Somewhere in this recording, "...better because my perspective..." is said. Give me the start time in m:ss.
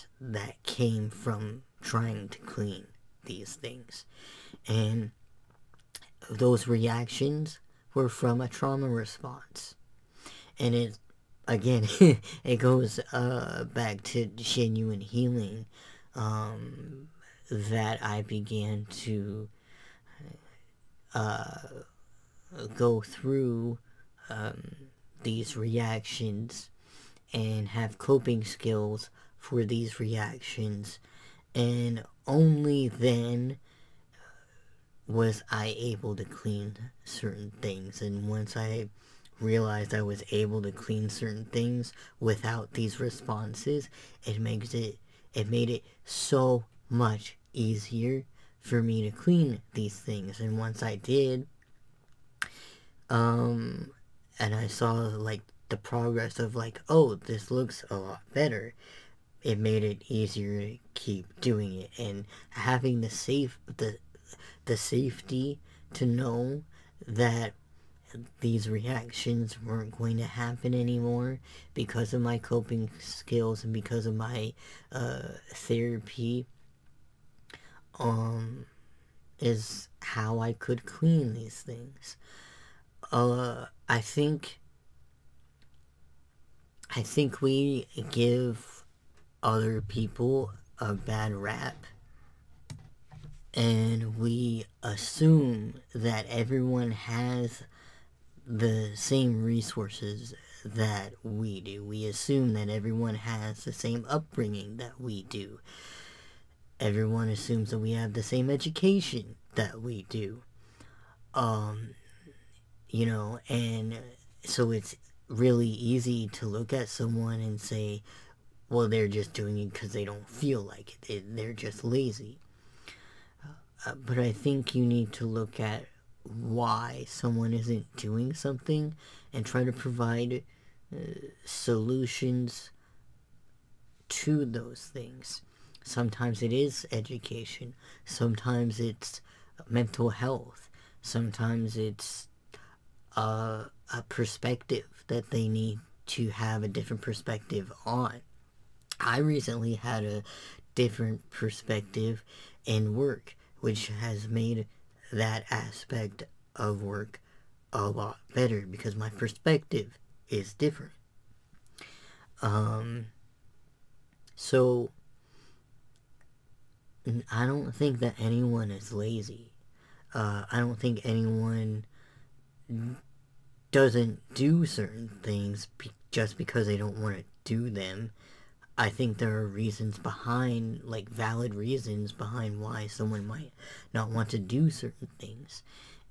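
2:38.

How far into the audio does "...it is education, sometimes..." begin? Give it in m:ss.
2:16.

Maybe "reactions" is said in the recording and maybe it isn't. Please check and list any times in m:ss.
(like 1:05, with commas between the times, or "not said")
0:06, 0:25, 0:30, 1:08.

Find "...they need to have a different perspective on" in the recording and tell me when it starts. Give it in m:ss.
2:25.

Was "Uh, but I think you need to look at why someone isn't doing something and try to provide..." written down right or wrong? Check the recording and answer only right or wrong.
right.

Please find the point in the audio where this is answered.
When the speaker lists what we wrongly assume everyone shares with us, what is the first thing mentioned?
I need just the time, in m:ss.
1:39.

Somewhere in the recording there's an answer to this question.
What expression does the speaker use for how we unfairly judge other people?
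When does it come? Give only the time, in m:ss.
1:30.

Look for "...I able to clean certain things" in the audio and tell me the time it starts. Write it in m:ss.
0:35.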